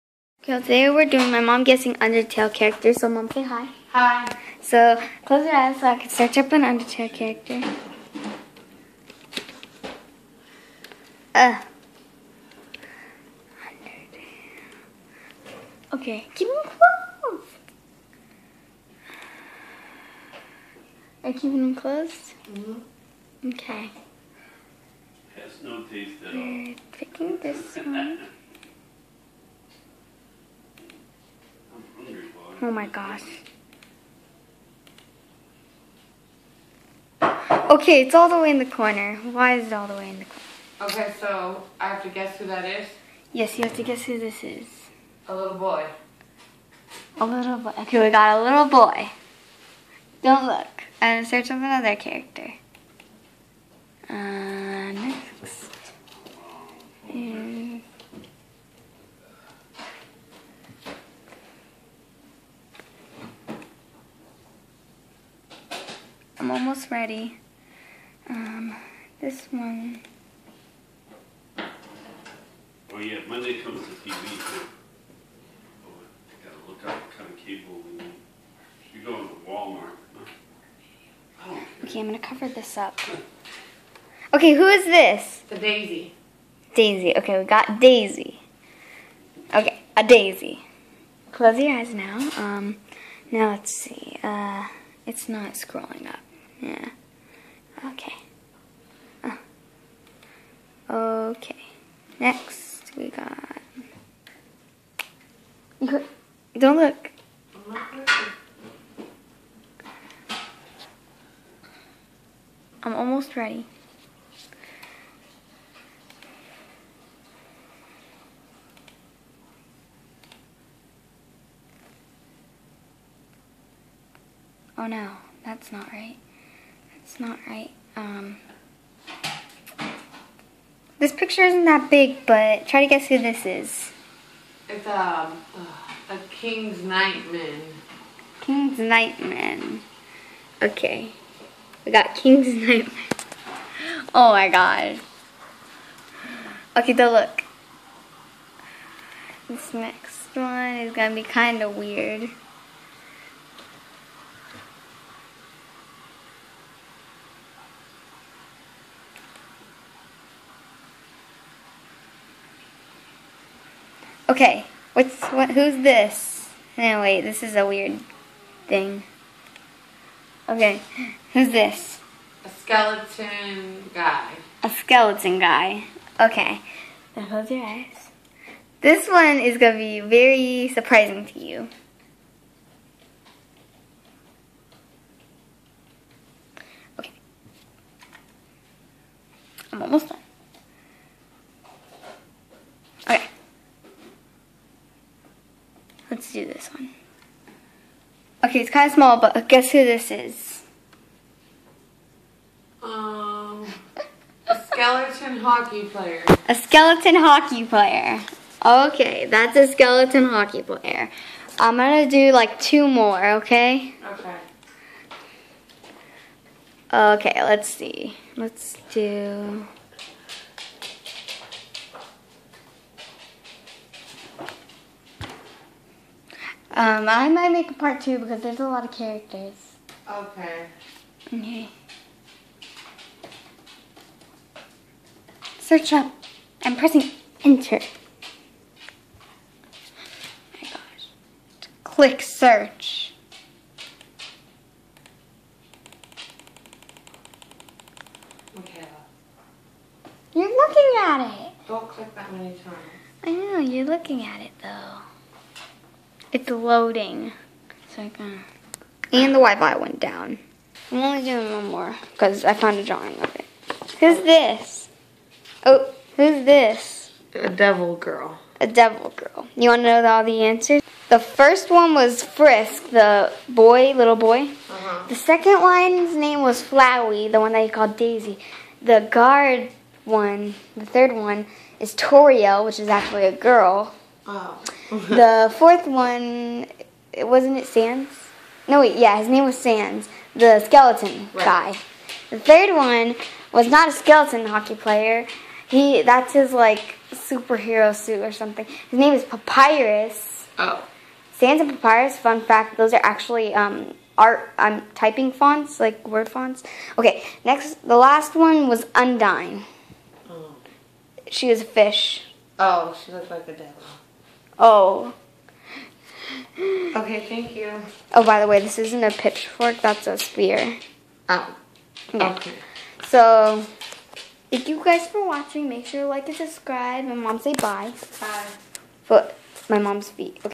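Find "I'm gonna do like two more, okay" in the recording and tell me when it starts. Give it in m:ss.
3:31.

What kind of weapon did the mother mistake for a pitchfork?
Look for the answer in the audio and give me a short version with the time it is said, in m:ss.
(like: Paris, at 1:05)
Spear, at 5:20.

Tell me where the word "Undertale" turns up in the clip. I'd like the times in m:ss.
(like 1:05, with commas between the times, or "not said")
0:01, 0:06.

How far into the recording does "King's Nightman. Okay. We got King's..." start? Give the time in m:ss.
2:18.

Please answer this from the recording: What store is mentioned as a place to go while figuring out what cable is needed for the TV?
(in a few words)
Walmart.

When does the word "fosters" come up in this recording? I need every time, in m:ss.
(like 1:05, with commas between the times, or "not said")
not said.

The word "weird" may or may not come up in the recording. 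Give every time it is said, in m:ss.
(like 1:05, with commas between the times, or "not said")
2:31, 2:47.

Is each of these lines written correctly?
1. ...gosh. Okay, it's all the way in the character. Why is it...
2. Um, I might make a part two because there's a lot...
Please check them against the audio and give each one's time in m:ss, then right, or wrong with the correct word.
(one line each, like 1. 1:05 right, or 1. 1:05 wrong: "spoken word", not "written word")
1. 0:32 wrong: "corner", not "character"
2. 3:46 right.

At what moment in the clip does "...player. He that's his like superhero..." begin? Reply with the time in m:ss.
4:54.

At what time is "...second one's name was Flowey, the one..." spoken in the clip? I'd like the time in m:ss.
4:35.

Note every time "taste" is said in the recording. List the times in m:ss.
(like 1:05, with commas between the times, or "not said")
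0:25.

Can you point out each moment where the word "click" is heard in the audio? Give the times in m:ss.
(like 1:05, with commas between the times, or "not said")
4:01, 4:11.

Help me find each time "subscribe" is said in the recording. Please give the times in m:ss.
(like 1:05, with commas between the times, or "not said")
5:26.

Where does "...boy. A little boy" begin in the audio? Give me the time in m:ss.
0:45.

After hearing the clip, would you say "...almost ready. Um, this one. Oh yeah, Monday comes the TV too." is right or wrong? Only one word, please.
right.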